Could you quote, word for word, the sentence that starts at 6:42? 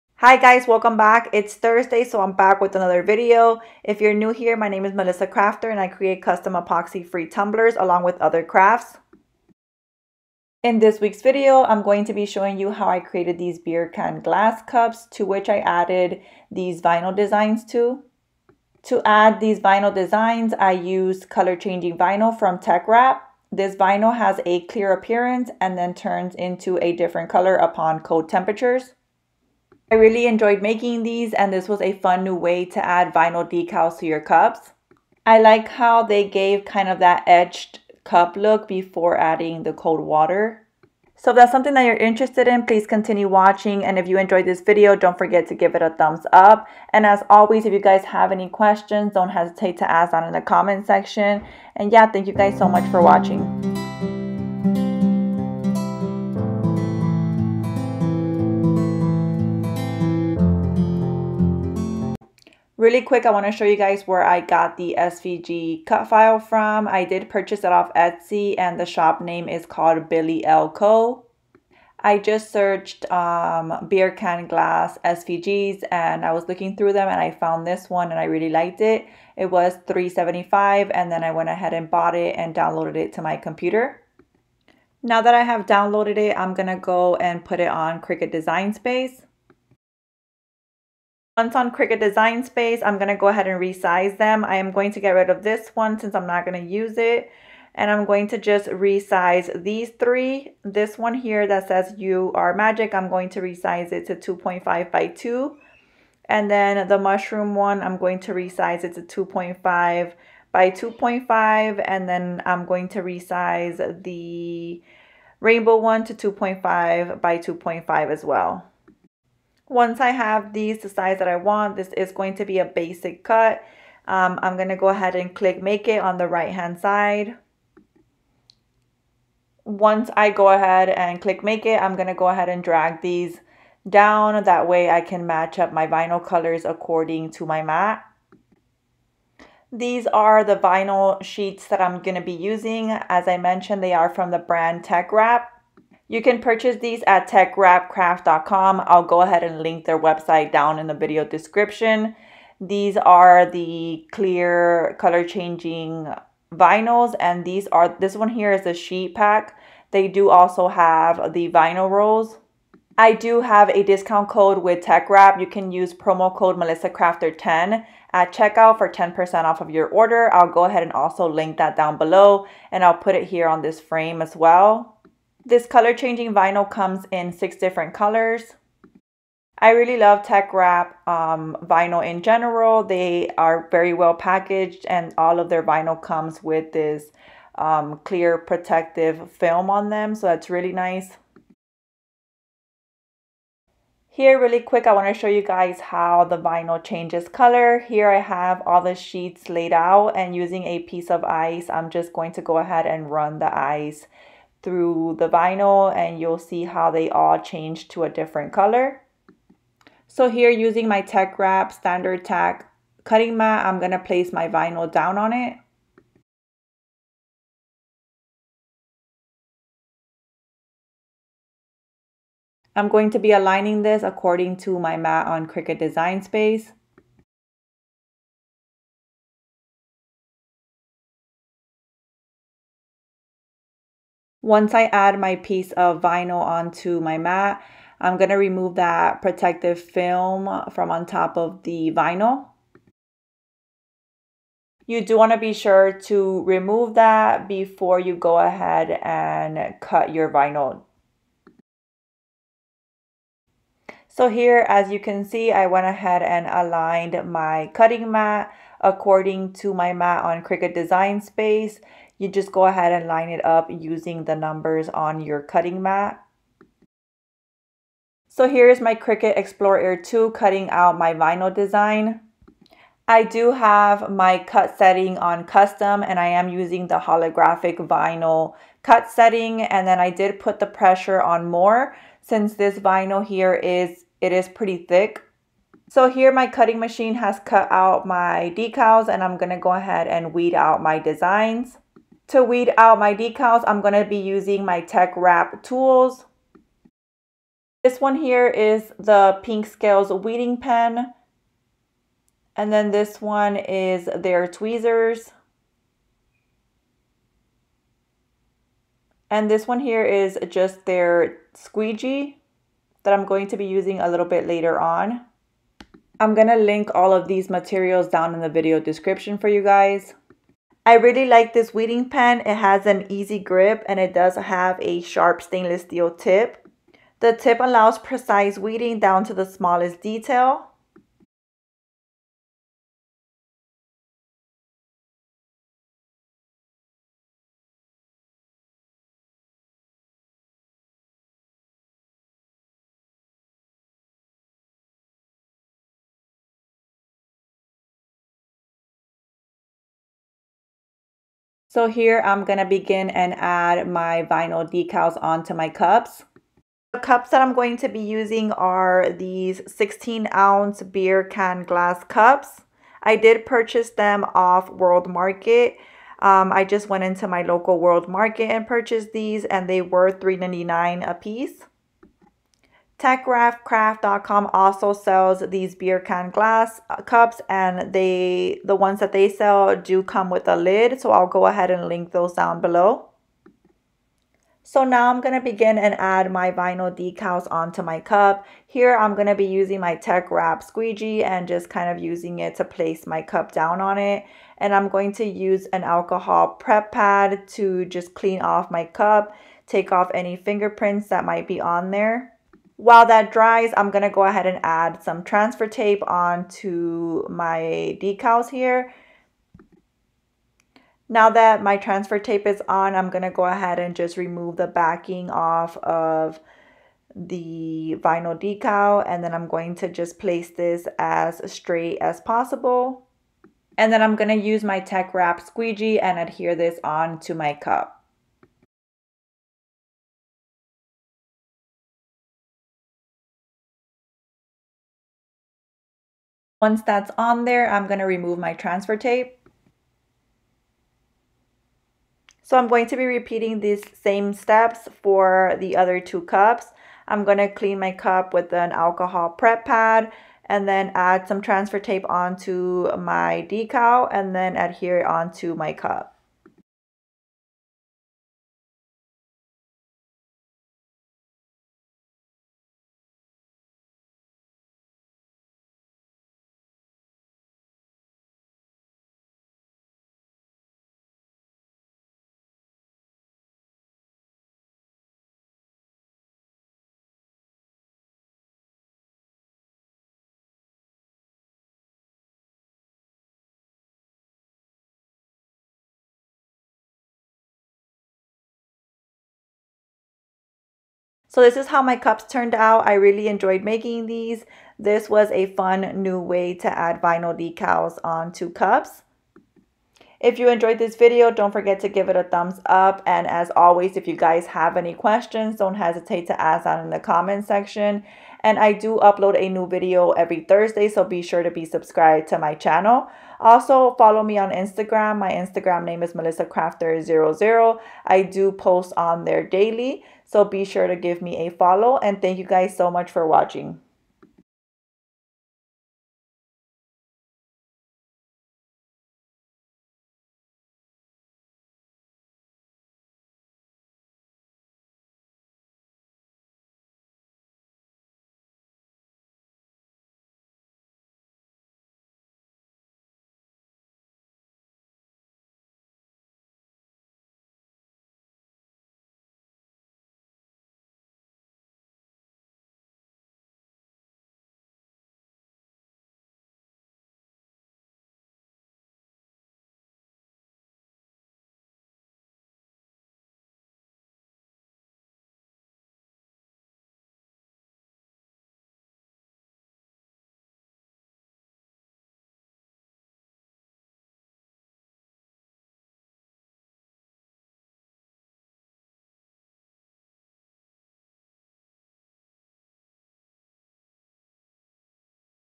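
While that dries, I'm going to go ahead and add some transfer tape onto my decals here.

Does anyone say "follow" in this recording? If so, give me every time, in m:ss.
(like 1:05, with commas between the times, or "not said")
8:33, 8:41.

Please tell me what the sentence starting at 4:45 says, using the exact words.
So here my cutting machine has cut out my decals and I'm going to go ahead and weed out my designs.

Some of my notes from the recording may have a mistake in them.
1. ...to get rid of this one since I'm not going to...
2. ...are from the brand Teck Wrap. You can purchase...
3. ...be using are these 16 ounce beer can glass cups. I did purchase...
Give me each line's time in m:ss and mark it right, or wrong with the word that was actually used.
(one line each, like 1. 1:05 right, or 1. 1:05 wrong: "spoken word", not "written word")
1. 1:34 right
2. 2:23 right
3. 5:57 right.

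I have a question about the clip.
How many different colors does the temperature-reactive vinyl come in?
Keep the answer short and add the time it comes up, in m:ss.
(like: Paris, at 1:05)
6, at 2:57.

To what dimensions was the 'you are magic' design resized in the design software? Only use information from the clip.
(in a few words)
2.5 by 2.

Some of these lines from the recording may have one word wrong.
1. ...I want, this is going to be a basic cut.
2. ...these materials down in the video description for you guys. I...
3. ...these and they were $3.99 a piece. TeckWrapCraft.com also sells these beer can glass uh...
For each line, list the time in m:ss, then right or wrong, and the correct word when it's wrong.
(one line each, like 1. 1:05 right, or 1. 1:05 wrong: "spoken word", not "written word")
1. 2:01 right
2. 5:17 right
3. 6:09 right.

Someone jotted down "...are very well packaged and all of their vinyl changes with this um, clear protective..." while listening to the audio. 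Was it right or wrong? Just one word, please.
wrong.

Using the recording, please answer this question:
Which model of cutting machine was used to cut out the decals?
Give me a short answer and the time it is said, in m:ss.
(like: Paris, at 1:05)
Cricut Explore Air 2, at 4:28.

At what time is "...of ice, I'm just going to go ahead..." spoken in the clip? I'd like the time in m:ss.
3:21.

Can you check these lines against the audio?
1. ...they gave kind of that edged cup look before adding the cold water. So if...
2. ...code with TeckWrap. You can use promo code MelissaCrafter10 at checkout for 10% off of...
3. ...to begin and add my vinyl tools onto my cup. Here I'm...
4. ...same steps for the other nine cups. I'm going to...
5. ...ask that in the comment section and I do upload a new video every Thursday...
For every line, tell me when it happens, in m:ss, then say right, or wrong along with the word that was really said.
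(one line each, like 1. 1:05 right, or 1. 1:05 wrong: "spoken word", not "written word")
1. 0:36 right
2. 2:44 right
3. 6:25 wrong: "decals", not "tools"
4. 7:24 wrong: "two", not "nine"
5. 8:26 right.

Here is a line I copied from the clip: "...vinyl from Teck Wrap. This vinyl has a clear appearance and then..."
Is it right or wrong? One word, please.
right.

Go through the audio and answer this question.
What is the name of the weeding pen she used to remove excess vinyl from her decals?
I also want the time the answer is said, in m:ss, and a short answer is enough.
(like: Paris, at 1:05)
Pink Scales, at 4:59.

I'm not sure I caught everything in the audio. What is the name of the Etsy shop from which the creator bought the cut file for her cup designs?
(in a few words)
Billy L. Co.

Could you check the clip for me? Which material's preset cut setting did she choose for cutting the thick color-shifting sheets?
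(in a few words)
holographic vinyl.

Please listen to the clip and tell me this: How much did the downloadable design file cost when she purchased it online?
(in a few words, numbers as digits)
$3.75.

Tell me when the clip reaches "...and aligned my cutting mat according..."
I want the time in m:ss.
4:16.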